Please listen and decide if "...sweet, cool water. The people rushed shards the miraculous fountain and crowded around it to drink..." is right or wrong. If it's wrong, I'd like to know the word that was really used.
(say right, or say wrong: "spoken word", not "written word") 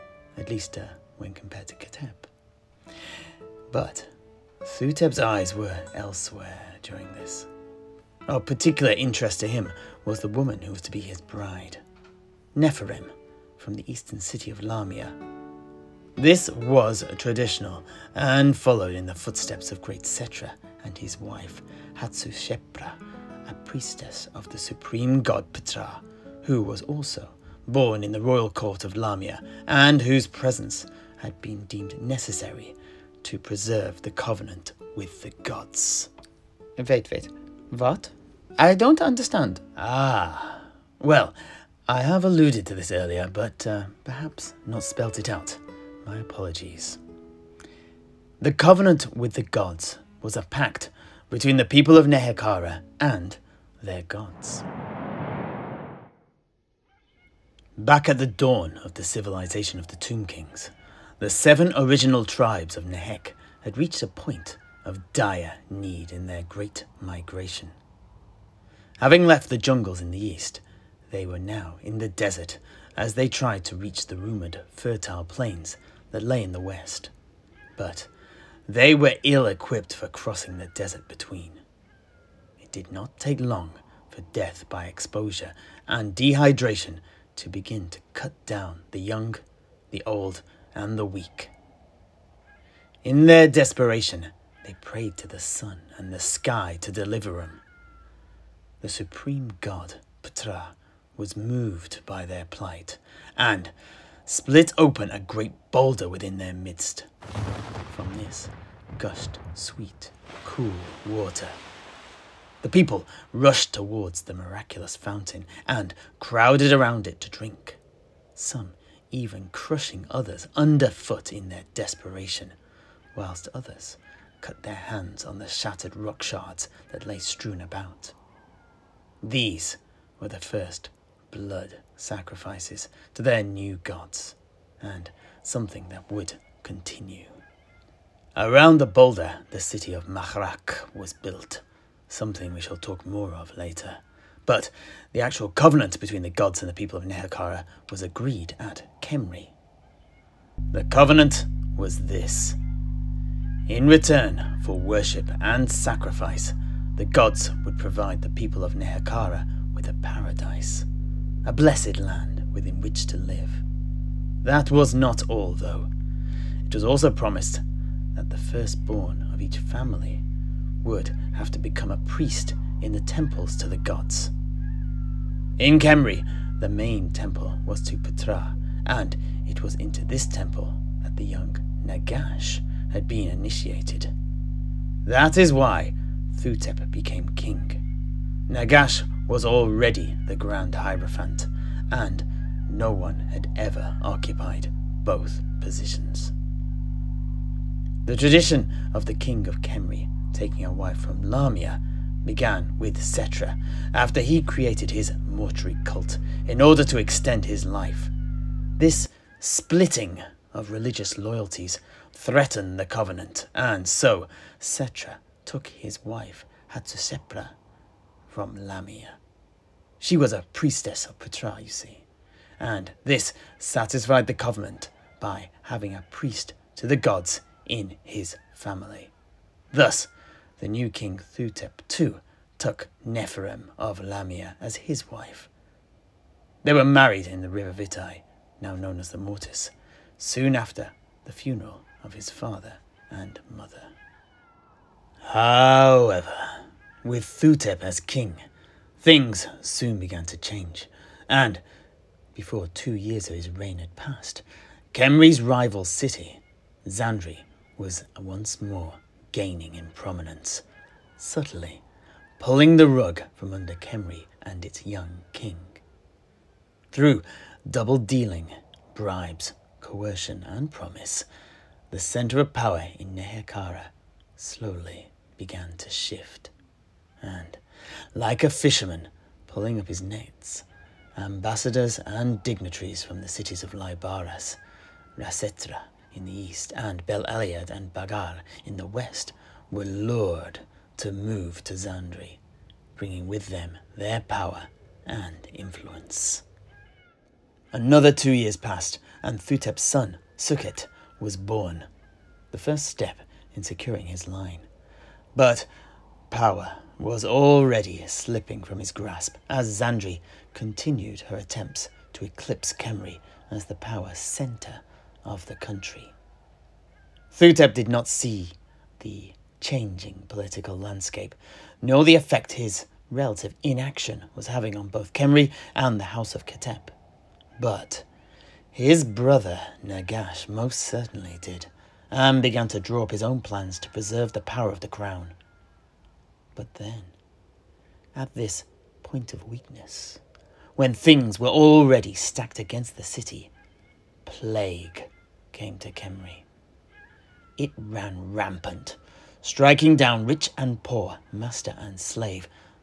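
wrong: "towards", not "shards".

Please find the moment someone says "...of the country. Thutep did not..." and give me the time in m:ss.
5:15.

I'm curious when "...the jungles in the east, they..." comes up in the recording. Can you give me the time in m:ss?
1:09.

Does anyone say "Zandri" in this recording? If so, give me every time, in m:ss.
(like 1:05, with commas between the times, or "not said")
4:16, 4:51, 5:09.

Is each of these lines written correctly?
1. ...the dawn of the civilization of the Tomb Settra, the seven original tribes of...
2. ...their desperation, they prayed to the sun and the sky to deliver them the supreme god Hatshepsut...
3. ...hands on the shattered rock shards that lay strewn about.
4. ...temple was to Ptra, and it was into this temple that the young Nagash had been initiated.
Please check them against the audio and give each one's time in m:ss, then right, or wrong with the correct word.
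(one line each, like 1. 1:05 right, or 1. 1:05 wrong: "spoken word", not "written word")
1. 0:58 wrong: "Kings", not "Settra"
2. 1:33 wrong: "Ptah", not "Hatshepsut"
3. 2:04 right
4. 2:57 right.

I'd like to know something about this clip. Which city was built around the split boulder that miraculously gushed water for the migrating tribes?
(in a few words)
Mahrak.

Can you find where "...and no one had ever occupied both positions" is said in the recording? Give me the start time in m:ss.
3:11.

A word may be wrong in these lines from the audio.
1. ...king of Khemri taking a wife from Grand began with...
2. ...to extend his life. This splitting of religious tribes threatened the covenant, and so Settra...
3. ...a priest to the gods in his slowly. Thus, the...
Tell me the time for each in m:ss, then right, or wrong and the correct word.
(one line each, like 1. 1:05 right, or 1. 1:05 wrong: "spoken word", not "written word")
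1. 3:19 wrong: "Lahmia", not "Grand"
2. 3:26 wrong: "loyalties", not "tribes"
3. 3:45 wrong: "family", not "slowly".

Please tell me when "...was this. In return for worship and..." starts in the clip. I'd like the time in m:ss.
2:31.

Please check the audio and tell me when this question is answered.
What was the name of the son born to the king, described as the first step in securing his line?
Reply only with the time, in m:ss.
4:59.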